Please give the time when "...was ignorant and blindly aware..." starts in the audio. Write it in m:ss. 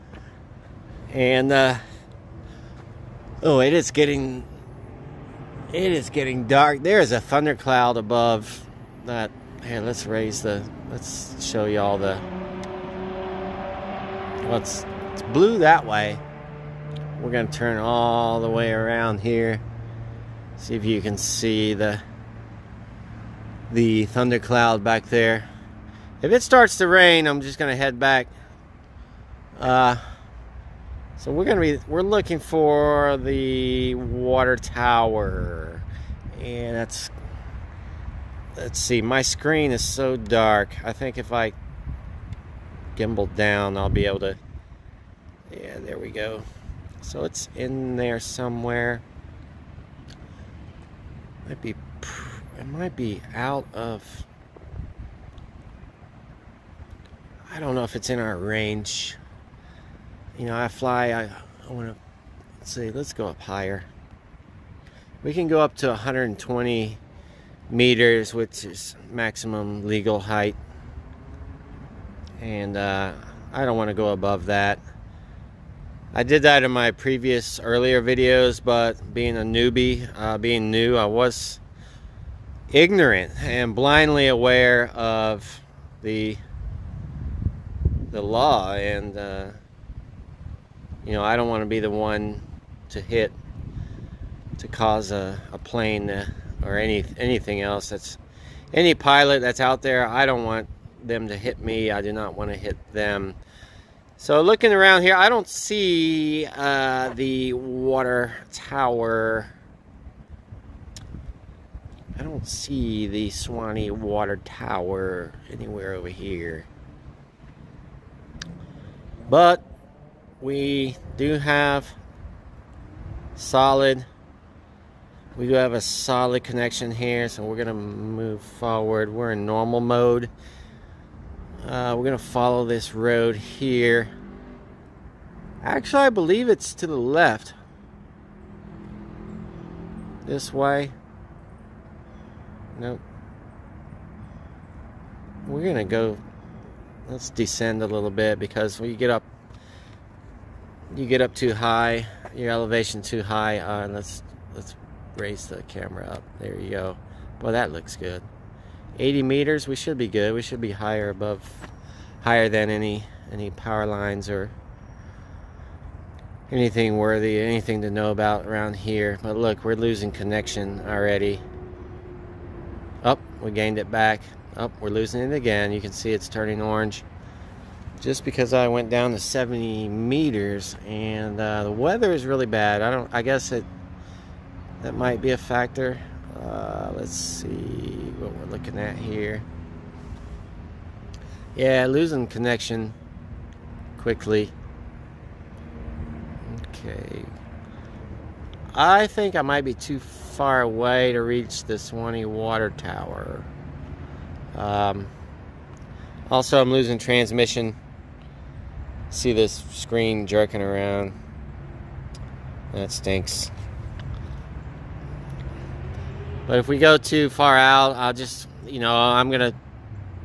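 1:21.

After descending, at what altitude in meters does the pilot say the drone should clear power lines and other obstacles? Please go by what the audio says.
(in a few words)
80.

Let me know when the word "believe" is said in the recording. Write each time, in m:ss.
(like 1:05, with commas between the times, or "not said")
2:16.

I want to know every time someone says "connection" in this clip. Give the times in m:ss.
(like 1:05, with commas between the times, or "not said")
2:06, 2:50, 3:12.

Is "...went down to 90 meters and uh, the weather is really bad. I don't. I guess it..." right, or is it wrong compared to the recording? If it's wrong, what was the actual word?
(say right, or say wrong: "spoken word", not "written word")
wrong: "70", not "90".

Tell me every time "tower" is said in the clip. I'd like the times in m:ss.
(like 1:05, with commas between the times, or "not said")
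0:34, 1:48, 1:54, 3:22.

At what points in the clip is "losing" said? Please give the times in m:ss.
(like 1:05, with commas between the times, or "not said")
2:49, 2:54, 3:11, 3:26.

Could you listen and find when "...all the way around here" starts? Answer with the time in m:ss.
0:17.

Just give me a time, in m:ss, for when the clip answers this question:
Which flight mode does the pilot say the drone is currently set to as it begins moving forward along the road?
2:09.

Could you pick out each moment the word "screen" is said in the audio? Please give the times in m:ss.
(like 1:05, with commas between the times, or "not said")
0:39, 3:29.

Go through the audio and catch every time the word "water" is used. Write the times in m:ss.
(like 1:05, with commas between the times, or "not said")
0:33, 1:47, 1:53, 3:22.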